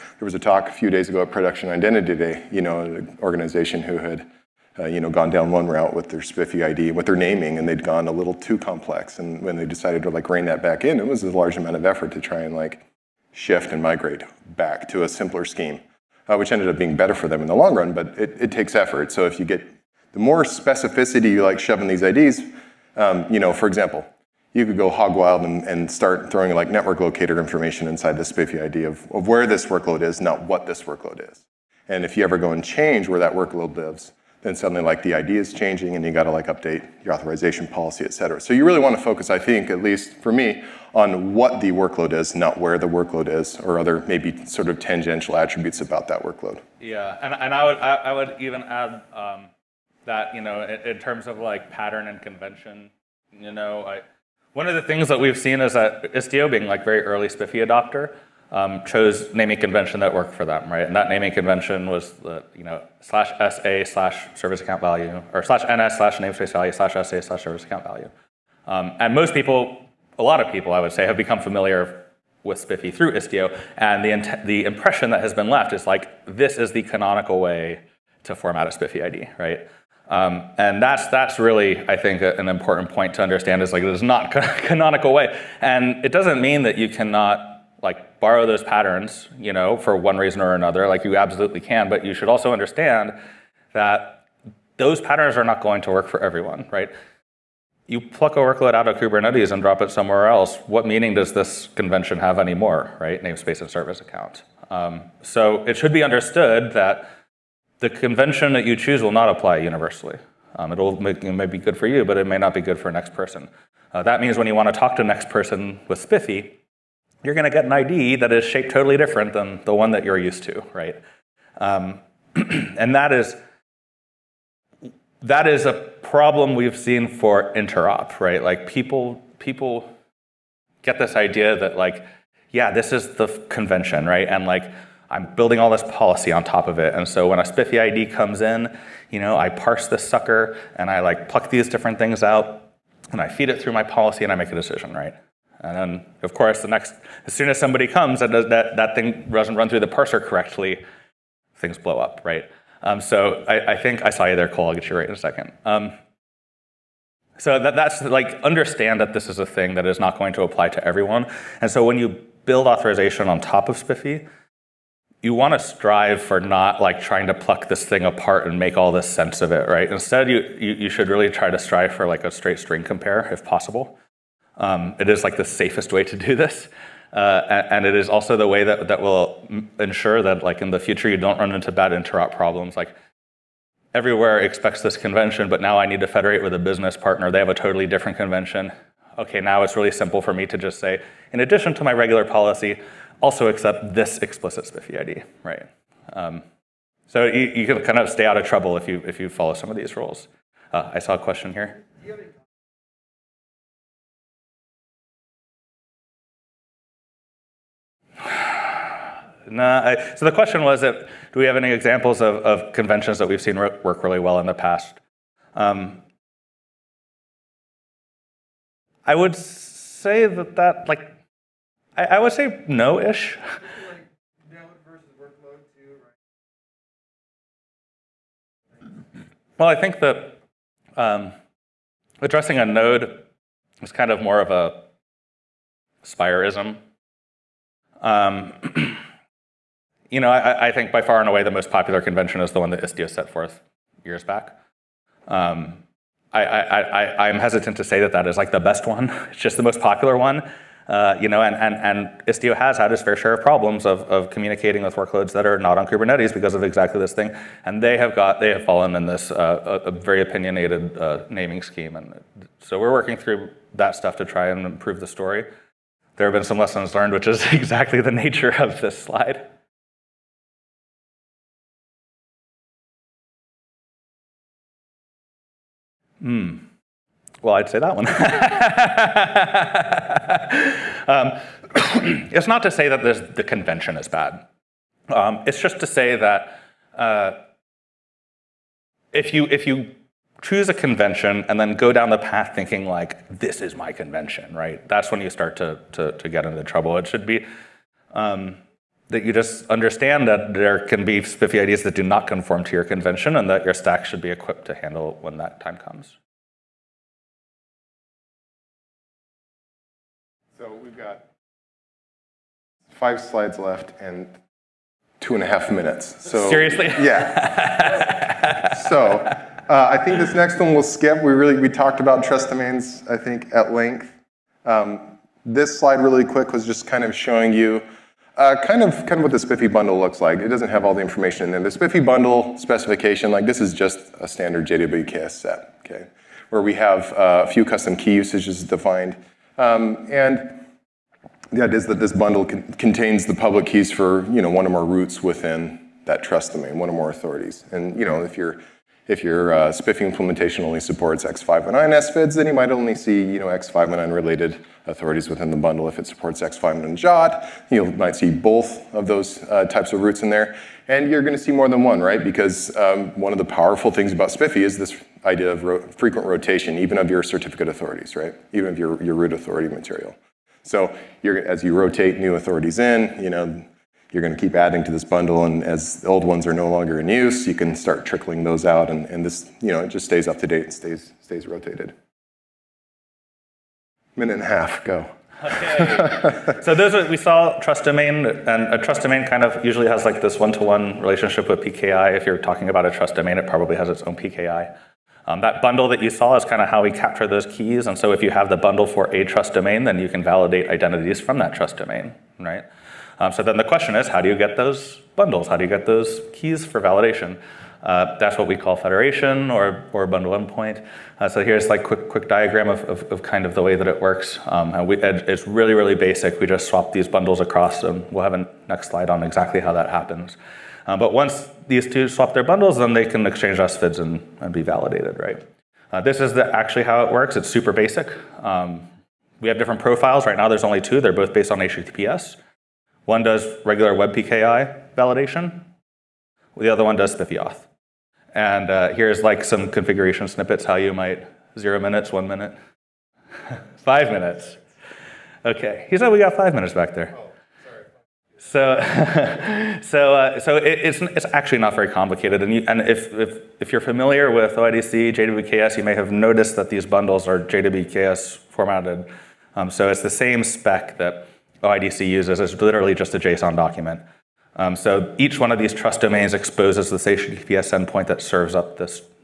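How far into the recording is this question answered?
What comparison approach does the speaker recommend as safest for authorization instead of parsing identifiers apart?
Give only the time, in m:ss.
2:52.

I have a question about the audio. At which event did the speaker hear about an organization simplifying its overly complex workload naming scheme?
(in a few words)
Production Identity Day.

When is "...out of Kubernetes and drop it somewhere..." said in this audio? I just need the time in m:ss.
1:38.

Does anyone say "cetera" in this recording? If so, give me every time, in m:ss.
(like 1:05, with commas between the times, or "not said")
0:38.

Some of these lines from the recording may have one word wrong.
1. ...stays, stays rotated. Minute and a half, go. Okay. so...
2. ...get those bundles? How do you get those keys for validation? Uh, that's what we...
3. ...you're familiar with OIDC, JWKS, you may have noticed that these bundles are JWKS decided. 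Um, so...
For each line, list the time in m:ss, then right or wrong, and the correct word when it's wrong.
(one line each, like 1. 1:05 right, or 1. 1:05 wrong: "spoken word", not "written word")
1. 6:20 right
2. 6:44 right
3. 7:33 wrong: "formatted", not "decided".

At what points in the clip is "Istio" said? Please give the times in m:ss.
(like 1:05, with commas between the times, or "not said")
0:56, 1:13, 4:02, 4:12.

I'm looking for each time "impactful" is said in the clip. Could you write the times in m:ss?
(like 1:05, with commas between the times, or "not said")
not said.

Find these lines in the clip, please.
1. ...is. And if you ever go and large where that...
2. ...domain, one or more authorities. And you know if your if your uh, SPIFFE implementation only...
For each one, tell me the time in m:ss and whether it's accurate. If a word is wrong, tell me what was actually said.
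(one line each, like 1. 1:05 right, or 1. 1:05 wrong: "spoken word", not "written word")
1. 0:31 wrong: "change", not "large"
2. 5:46 right.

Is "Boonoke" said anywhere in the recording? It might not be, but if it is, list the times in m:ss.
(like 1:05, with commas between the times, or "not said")
not said.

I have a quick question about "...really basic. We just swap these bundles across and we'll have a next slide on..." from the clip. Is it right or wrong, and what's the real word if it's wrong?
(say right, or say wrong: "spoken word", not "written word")
right.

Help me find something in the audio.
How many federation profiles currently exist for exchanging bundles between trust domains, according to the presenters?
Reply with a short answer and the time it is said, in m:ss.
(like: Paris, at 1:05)
2, at 7:10.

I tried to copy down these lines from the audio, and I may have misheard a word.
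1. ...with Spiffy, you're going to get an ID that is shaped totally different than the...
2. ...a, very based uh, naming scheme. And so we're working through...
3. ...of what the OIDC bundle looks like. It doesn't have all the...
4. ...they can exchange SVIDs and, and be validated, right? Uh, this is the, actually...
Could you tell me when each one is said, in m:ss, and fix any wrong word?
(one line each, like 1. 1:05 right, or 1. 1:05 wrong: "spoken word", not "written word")
1. 1:55 right
2. 4:19 wrong: "opinionated", not "based"
3. 5:29 wrong: "SPIFFE", not "OIDC"
4. 7:02 right.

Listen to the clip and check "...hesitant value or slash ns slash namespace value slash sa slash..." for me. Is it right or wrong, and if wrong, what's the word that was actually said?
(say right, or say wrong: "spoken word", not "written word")
wrong: "account", not "hesitant".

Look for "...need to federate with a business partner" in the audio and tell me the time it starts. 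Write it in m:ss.
3:05.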